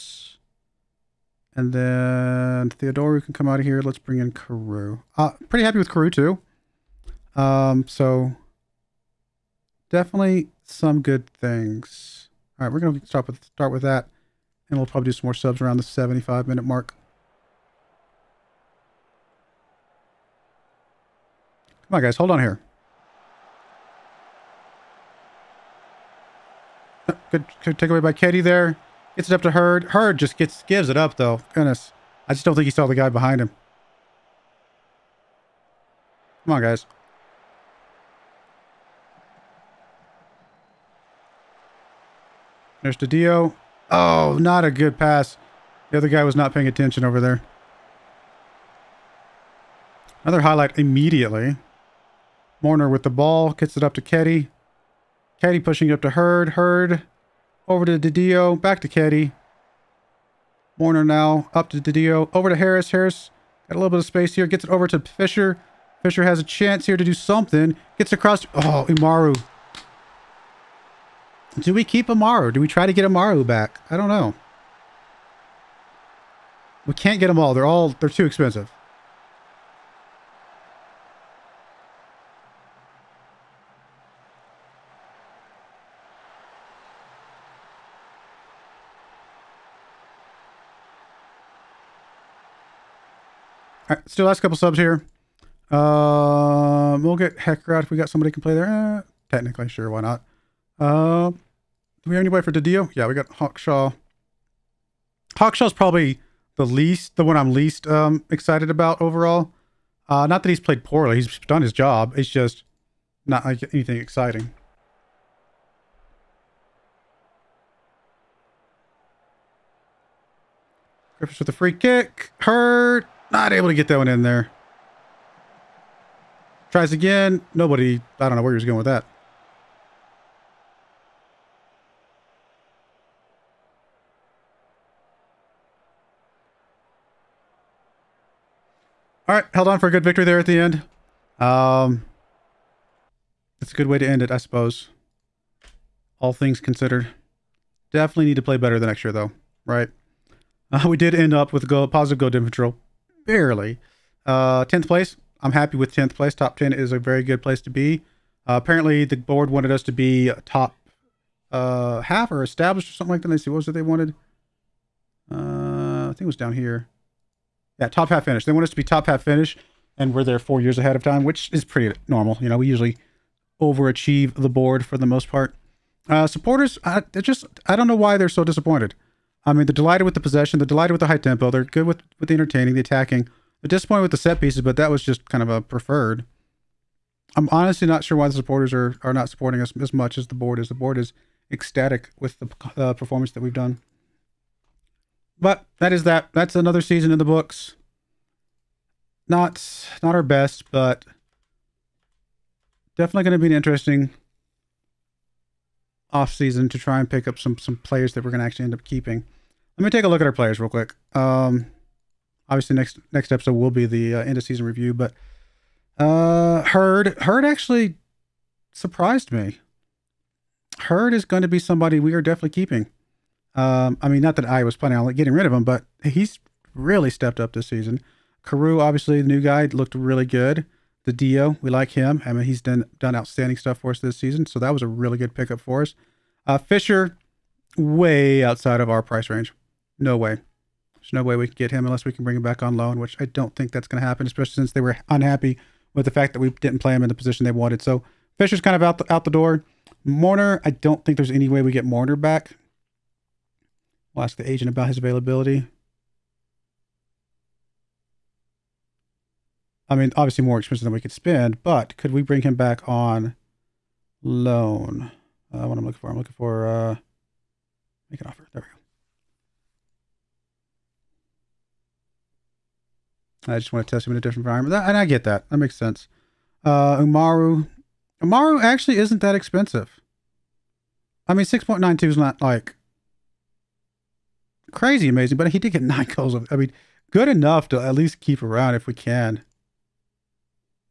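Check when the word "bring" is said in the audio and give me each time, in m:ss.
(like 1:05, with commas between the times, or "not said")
0:03, 4:02, 4:22.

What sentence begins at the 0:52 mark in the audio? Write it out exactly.
Mourner with the ball, gets it up to Keddie.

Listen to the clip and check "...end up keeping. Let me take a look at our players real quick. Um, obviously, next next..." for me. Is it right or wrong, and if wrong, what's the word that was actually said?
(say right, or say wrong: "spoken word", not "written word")
right.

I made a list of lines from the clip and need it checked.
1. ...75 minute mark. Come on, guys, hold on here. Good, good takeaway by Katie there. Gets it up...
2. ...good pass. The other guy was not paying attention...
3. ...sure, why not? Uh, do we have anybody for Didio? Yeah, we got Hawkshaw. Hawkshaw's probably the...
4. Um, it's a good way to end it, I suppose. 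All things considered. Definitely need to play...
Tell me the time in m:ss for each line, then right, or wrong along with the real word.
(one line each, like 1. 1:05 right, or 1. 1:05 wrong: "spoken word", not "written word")
1. 0:15 right
2. 0:44 right
3. 1:39 right
4. 2:21 right.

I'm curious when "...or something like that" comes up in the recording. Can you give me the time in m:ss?
2:42.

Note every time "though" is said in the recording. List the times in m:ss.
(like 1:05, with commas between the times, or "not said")
0:31, 2:29.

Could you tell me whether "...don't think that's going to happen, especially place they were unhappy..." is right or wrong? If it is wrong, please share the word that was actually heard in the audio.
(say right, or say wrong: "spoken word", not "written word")
wrong: "since", not "place".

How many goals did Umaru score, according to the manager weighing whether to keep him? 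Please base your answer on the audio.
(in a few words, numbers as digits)
9.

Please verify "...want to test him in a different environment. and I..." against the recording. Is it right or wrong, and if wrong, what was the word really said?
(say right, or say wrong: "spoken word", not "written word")
right.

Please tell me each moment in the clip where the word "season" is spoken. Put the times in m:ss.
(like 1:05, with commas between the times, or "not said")
3:16, 3:26, 3:34, 3:47, 3:54.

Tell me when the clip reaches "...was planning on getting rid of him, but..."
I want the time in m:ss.
3:44.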